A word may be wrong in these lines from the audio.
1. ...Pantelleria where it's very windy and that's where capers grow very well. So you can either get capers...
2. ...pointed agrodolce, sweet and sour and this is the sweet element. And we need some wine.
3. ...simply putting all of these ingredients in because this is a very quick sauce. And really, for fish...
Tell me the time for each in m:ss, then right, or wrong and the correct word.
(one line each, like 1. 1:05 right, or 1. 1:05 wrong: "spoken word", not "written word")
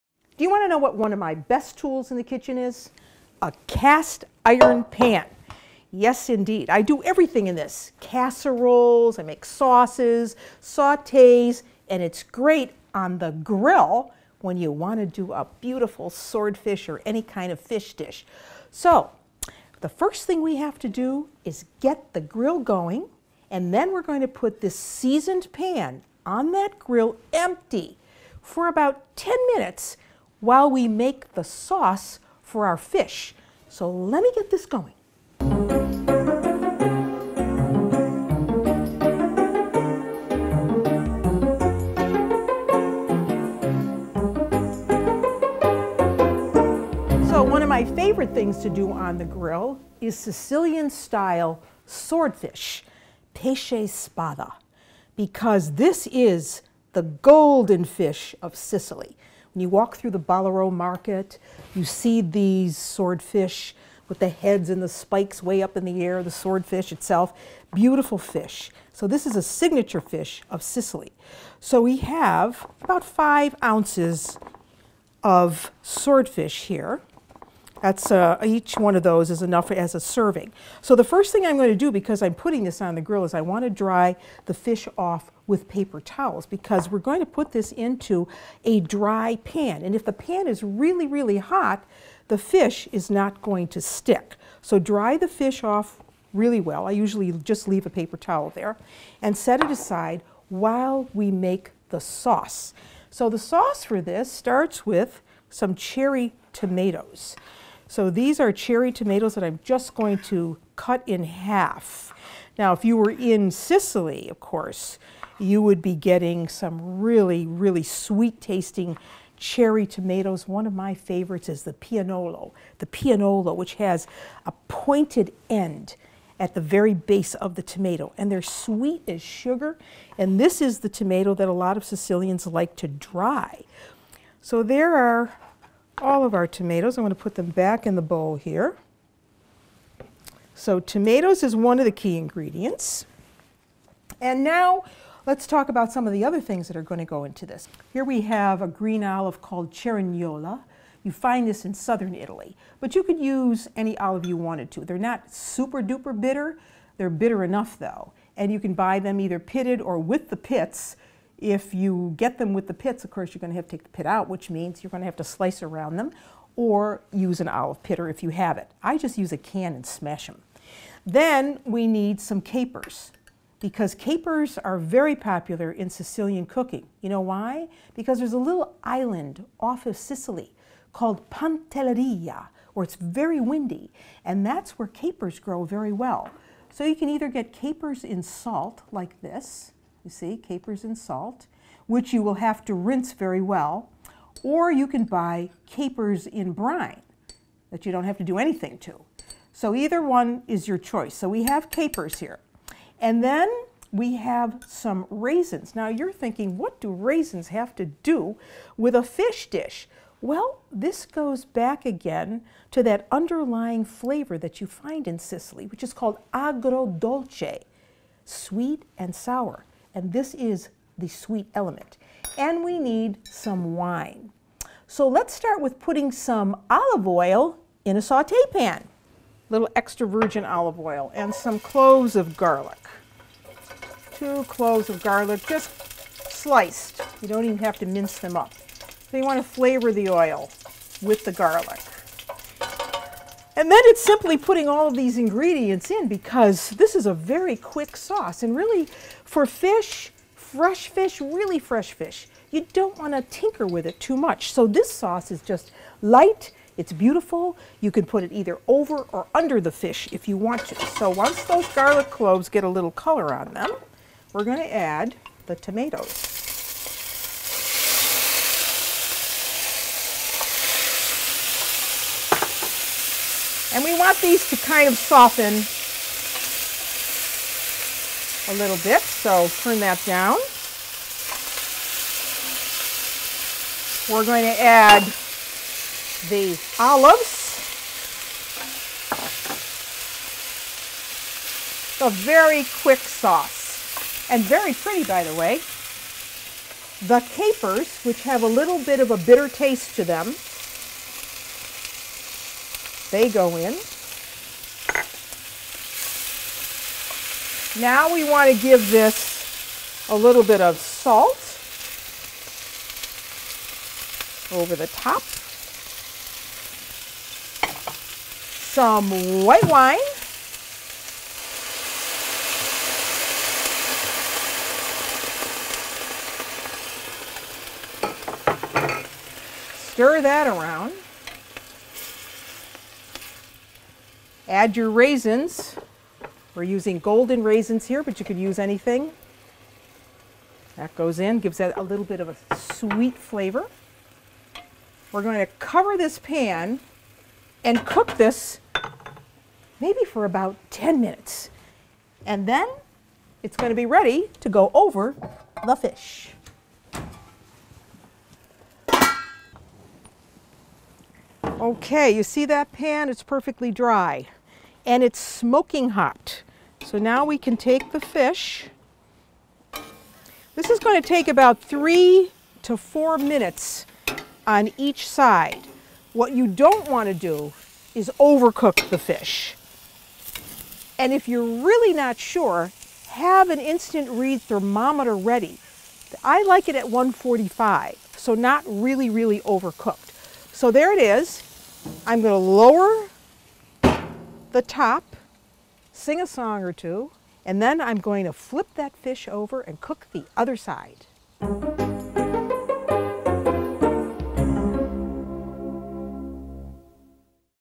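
1. 3:01 right
2. 3:35 wrong: "called", not "pointed"
3. 4:04 right.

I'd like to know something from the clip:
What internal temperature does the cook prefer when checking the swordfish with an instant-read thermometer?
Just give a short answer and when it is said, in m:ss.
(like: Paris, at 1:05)
145, at 6:26.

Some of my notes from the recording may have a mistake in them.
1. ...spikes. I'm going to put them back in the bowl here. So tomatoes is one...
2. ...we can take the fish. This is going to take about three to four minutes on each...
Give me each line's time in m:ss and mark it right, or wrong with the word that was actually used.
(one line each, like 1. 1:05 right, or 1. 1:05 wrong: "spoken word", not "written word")
1. 2:16 wrong: "tomatoes", not "spikes"
2. 6:07 right.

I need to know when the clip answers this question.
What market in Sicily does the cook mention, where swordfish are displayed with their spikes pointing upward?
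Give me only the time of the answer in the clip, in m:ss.
1:00.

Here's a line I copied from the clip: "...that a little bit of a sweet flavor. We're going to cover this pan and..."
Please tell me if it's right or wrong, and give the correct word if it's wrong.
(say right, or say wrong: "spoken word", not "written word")
right.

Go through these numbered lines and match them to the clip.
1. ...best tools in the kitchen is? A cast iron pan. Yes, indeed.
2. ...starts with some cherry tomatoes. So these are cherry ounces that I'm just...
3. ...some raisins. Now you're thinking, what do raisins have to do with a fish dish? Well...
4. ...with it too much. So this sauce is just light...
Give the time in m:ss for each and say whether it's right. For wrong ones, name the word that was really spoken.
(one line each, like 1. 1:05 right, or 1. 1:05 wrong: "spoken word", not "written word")
1. 0:01 right
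2. 1:44 wrong: "tomatoes", not "ounces"
3. 3:24 right
4. 4:13 right.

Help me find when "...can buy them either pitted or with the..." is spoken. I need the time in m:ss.
2:38.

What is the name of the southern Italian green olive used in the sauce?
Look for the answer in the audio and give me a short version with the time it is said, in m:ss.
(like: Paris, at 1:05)
cerignola, at 2:29.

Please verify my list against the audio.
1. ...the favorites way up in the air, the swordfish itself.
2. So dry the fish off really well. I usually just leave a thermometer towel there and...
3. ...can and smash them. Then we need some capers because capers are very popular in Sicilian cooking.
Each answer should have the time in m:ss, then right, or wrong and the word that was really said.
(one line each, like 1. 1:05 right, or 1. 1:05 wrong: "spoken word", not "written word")
1. 1:04 wrong: "spikes", not "favorites"
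2. 1:34 wrong: "paper", not "thermometer"
3. 2:49 right.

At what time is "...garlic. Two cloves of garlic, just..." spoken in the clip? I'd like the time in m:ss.
3:52.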